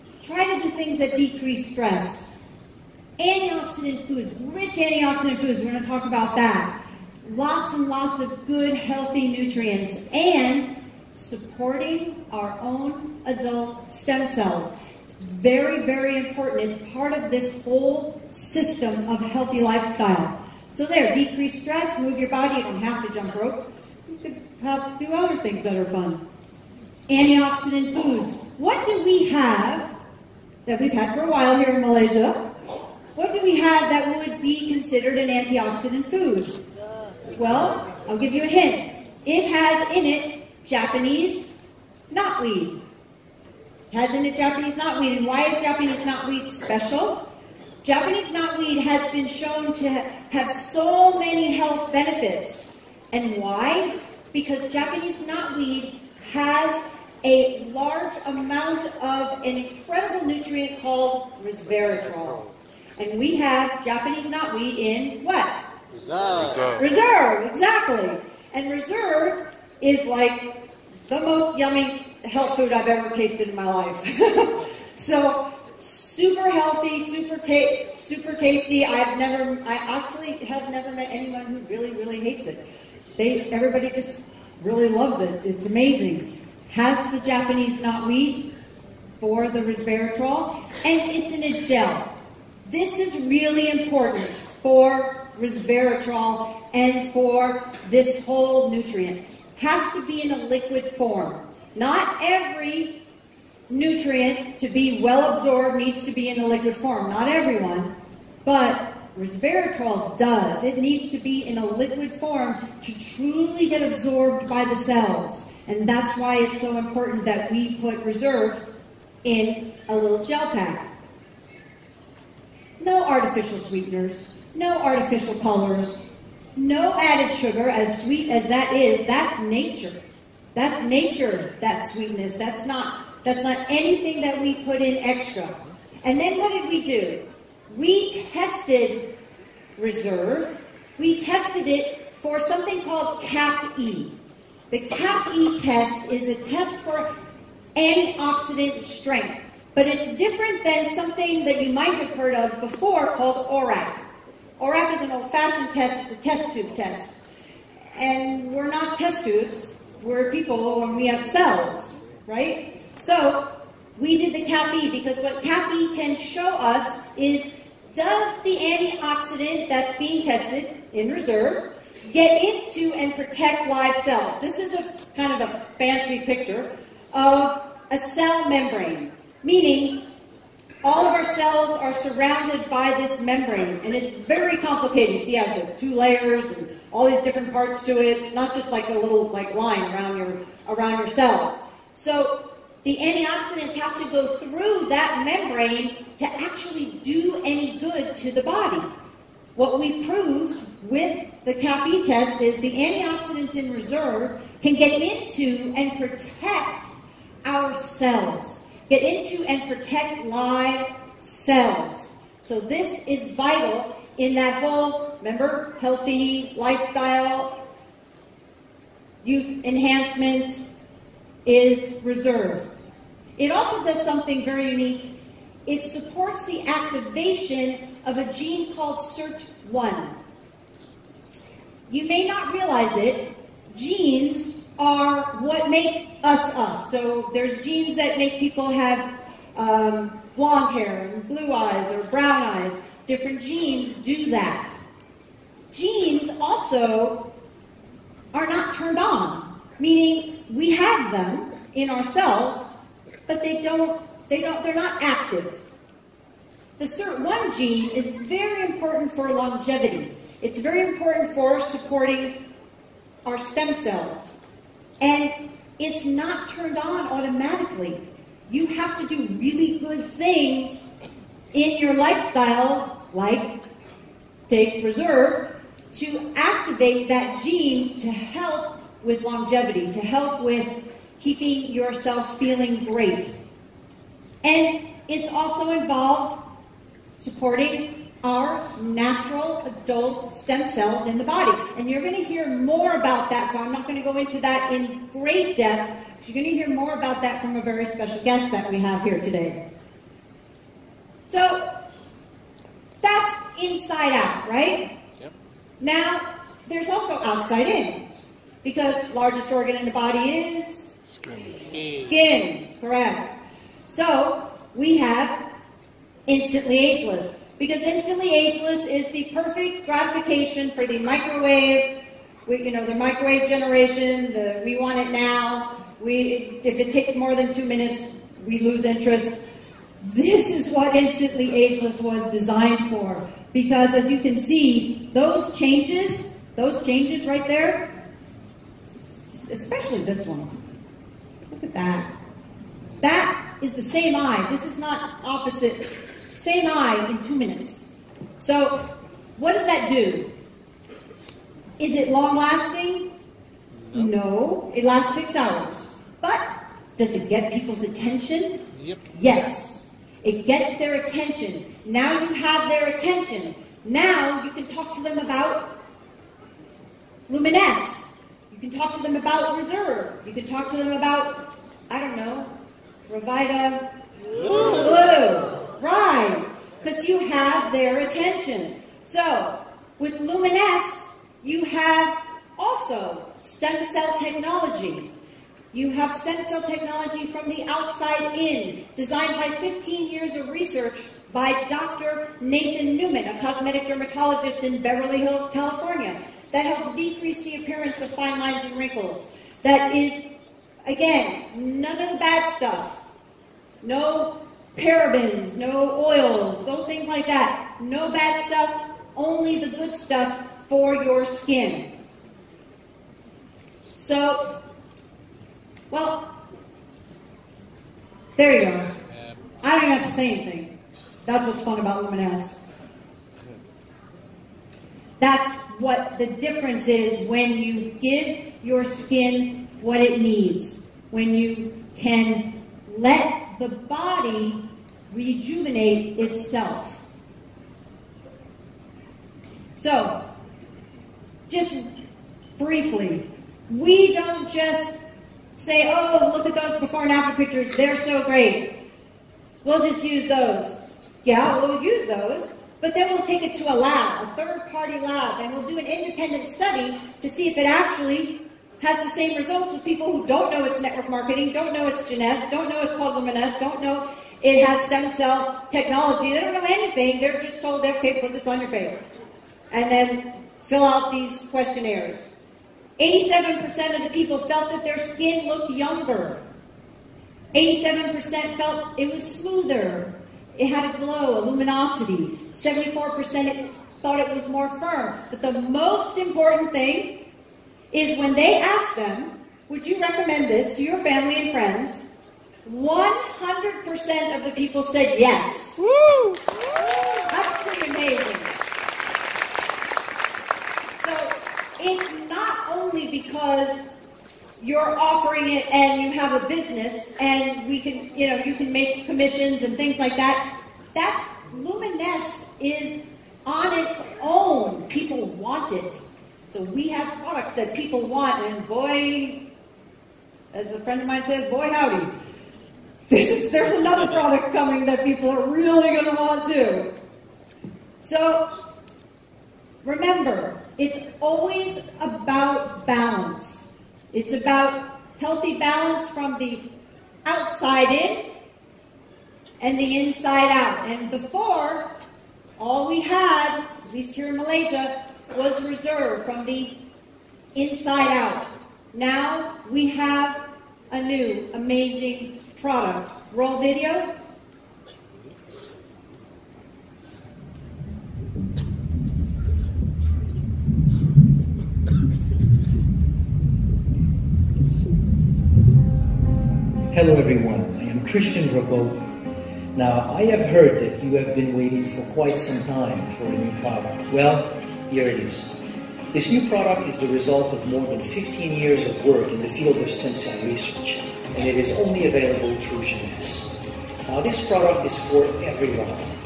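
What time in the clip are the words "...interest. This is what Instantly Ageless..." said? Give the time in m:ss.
5:28.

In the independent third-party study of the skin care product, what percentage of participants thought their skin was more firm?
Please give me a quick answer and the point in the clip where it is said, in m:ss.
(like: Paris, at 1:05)
74%, at 8:02.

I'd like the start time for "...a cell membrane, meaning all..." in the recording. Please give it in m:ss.
2:57.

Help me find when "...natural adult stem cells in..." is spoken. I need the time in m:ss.
4:48.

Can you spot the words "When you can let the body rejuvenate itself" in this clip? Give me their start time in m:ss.
7:11.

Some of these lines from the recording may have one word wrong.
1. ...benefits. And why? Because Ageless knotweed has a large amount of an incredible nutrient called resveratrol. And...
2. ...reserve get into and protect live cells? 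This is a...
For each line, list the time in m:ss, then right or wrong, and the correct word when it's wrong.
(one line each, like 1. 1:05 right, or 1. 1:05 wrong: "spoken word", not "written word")
1. 0:51 wrong: "Japanese", not "Ageless"
2. 2:51 right.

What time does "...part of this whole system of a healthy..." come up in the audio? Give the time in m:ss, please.
0:16.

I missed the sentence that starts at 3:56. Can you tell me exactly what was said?
So there's genes that make people have um, blonde hair and blue eyes or brown eyes.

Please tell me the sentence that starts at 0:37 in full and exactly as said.
Well, I'll give you a hint.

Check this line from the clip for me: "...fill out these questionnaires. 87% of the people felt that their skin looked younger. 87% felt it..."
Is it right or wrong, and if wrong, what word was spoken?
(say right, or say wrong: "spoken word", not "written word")
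right.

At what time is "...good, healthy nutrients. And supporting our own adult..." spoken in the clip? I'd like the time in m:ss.
0:08.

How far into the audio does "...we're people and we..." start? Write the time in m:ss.
2:40.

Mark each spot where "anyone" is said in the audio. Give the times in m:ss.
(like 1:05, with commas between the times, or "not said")
1:21.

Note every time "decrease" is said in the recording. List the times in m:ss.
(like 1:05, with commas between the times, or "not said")
0:01, 0:21, 6:36.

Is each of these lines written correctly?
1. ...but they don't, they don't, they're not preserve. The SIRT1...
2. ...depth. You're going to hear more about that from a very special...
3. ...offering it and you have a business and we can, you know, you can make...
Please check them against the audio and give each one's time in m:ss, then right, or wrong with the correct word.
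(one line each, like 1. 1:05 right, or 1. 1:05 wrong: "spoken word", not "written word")
1. 4:13 wrong: "active", not "preserve"
2. 4:55 right
3. 8:24 right.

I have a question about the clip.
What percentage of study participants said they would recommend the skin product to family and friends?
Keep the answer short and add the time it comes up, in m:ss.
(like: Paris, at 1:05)
100%, at 8:12.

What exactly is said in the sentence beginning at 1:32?
This is really important for resveratrol and for this whole nutrient.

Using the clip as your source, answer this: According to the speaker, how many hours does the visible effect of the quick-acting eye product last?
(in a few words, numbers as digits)
6.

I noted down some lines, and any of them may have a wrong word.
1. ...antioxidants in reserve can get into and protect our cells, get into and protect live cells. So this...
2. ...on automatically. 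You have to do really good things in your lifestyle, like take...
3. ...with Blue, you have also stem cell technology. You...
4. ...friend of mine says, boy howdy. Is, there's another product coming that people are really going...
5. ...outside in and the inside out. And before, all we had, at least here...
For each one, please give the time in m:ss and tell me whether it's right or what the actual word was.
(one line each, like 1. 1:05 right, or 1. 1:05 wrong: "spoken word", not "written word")
1. 3:22 right
2. 4:26 right
3. 6:19 wrong: "Luminesce", not "Blue"
4. 8:40 right
5. 8:57 right.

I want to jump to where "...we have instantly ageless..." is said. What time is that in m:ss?
5:14.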